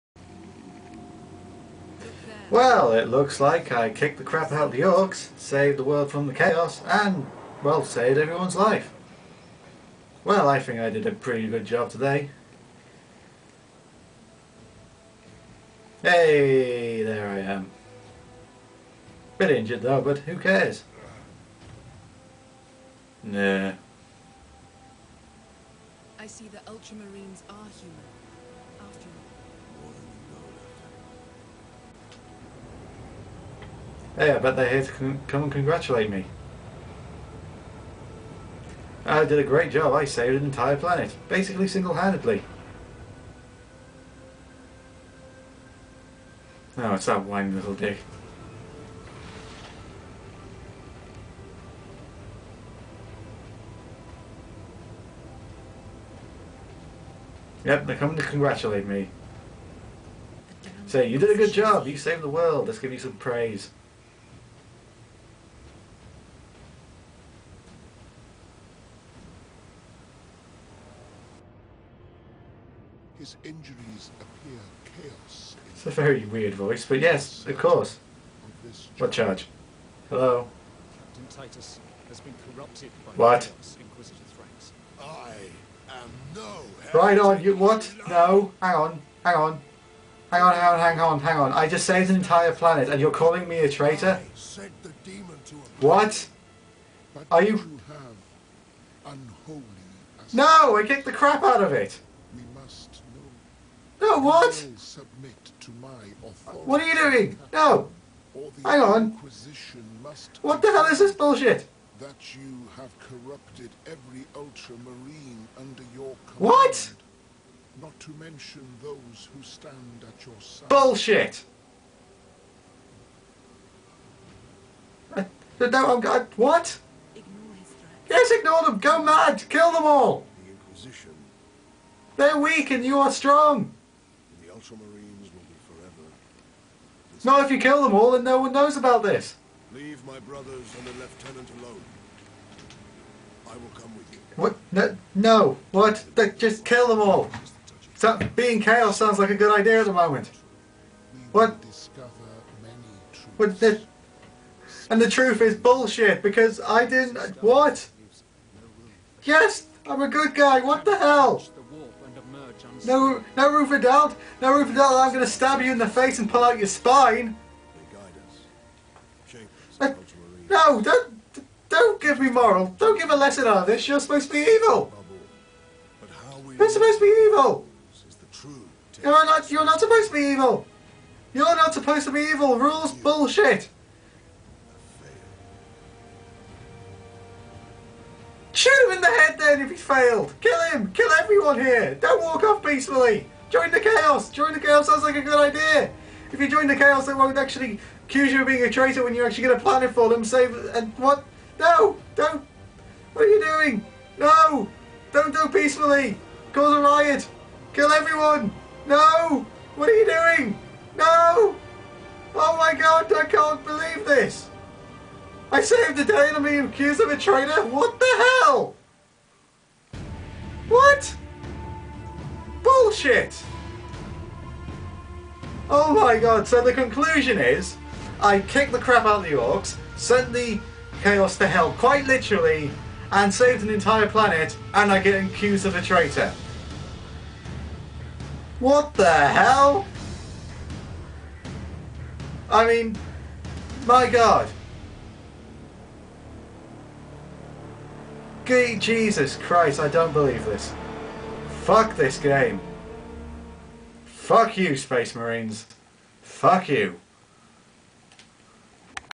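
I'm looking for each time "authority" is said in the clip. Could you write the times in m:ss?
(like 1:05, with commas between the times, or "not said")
1:46.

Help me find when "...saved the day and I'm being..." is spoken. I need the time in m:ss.
3:35.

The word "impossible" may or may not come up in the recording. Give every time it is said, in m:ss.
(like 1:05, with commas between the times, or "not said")
not said.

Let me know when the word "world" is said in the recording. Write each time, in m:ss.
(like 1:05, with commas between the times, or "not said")
0:05, 1:02.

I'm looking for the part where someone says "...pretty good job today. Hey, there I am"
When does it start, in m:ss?
0:11.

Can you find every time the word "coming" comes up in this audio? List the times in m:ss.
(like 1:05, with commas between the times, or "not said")
0:57.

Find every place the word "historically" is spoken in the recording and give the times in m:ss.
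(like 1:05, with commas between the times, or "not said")
not said.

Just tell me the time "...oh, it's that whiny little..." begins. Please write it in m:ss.
0:46.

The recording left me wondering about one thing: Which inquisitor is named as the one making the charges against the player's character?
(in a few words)
Thrax.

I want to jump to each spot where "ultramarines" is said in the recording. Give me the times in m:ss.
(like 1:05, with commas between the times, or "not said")
0:26, 1:54, 2:14.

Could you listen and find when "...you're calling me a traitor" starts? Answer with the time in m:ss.
1:32.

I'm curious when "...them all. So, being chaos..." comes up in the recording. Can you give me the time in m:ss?
2:26.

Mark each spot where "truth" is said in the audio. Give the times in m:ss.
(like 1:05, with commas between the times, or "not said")
2:35.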